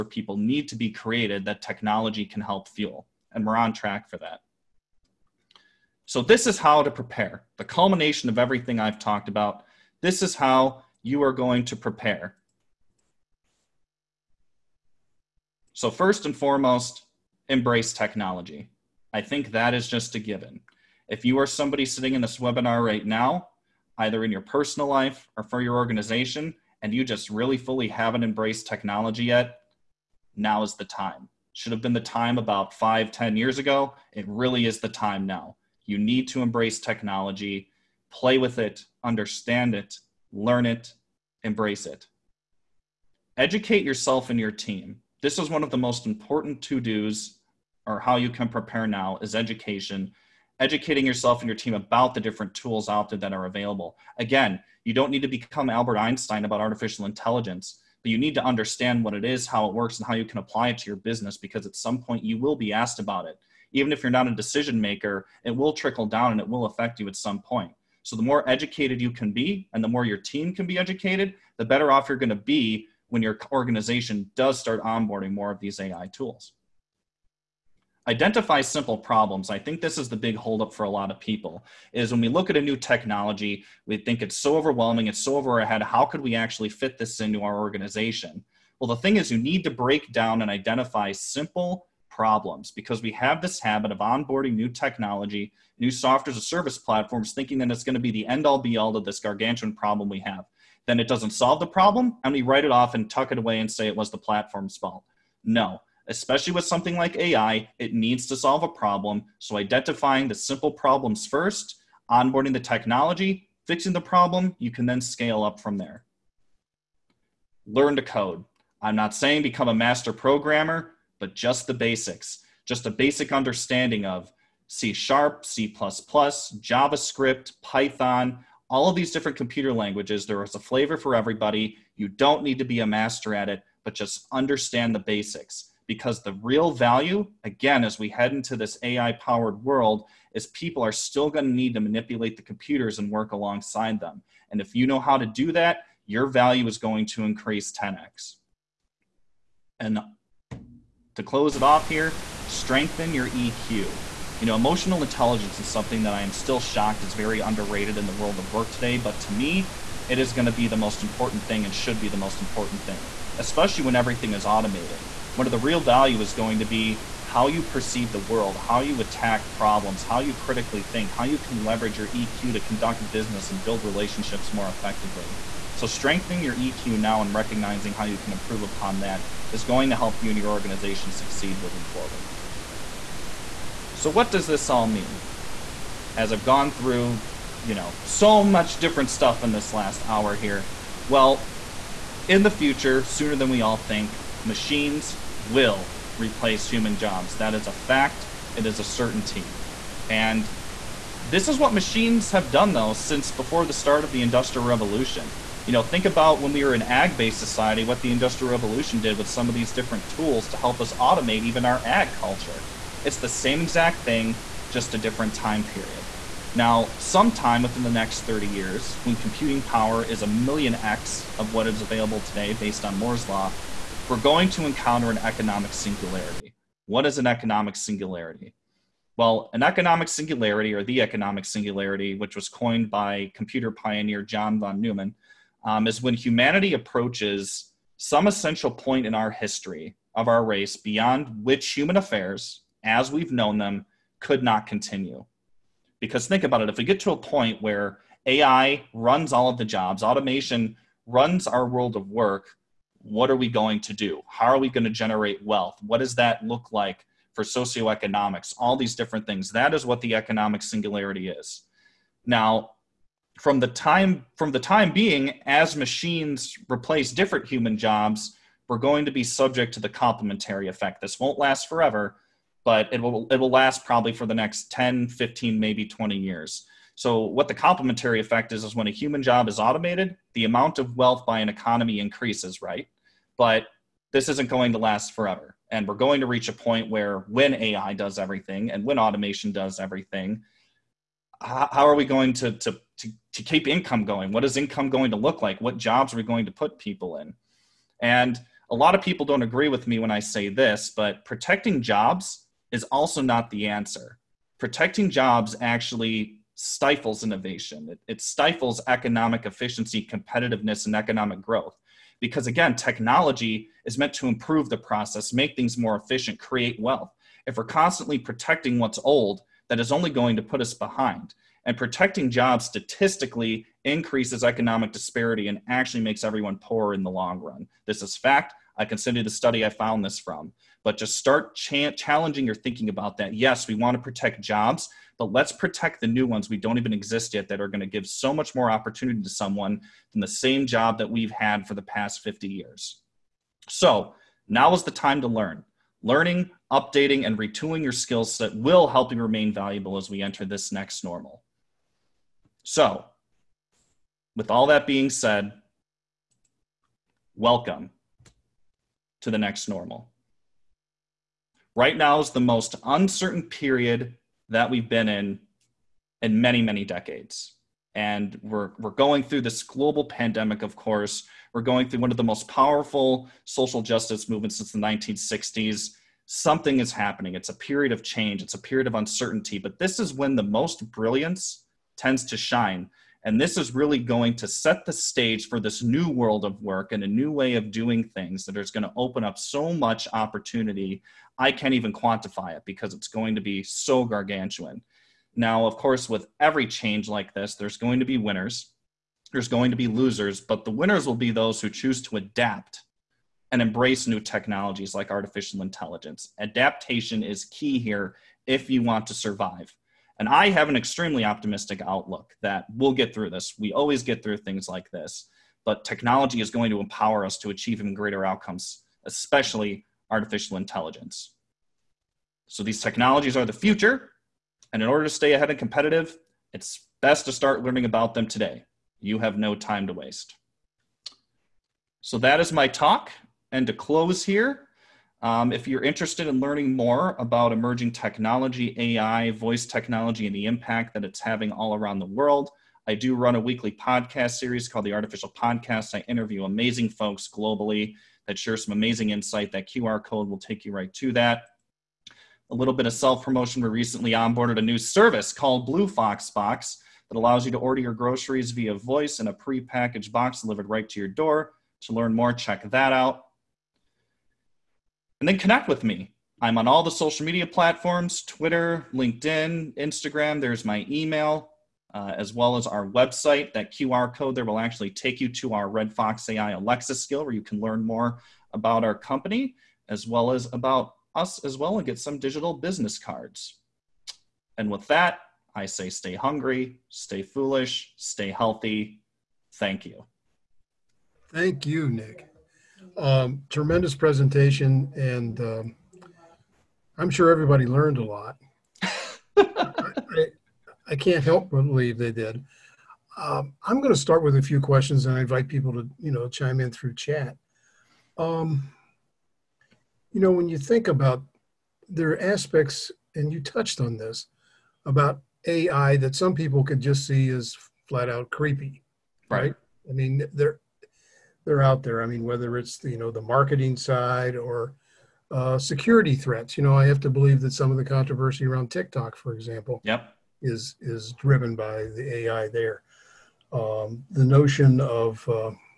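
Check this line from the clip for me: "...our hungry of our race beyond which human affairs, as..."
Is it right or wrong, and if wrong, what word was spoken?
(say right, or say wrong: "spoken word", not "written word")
wrong: "history", not "hungry".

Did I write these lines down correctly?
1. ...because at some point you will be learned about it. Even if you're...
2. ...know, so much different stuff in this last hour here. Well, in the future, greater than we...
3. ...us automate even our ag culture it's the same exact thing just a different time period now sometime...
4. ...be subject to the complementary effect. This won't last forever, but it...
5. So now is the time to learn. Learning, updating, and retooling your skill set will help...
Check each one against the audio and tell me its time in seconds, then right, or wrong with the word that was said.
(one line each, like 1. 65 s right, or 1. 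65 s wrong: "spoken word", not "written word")
1. 61 s wrong: "asked", not "learned"
2. 187 s wrong: "sooner", not "greater"
3. 210 s right
4. 269 s right
5. 343 s right.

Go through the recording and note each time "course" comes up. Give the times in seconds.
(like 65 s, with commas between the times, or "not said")
370 s, 395 s.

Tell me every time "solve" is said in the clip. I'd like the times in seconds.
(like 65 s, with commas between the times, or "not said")
101 s, 108 s.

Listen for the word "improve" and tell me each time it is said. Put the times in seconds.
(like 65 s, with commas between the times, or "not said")
178 s, 314 s.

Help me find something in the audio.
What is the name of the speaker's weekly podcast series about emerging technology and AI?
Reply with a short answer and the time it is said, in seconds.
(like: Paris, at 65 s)
Artificial Podcast, at 444 s.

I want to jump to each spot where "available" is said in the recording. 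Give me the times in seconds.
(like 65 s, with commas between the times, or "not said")
53 s, 221 s.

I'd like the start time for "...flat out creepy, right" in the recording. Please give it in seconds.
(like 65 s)
517 s.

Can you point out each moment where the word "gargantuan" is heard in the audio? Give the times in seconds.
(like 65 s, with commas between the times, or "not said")
99 s, 394 s.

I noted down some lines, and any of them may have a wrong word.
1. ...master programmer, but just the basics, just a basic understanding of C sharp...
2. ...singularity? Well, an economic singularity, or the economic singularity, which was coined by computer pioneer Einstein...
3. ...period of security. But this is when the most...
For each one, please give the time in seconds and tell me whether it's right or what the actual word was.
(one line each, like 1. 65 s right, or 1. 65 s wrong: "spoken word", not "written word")
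1. 119 s right
2. 227 s wrong: "John", not "Einstein"
3. 378 s wrong: "uncertainty", not "security".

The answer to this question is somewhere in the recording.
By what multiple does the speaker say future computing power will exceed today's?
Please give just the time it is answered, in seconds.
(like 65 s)
220 s.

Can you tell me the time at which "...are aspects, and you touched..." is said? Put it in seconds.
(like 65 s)
512 s.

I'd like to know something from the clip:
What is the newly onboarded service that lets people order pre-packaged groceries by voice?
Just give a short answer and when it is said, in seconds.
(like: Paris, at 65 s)
Blue Fox Box, at 455 s.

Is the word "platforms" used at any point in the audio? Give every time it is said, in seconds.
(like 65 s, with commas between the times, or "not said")
96 s, 104 s, 467 s.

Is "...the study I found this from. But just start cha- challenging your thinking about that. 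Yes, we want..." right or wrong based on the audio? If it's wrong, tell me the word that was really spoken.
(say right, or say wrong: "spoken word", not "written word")
right.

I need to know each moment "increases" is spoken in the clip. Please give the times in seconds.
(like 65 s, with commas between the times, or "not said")
147 s, 282 s, 323 s.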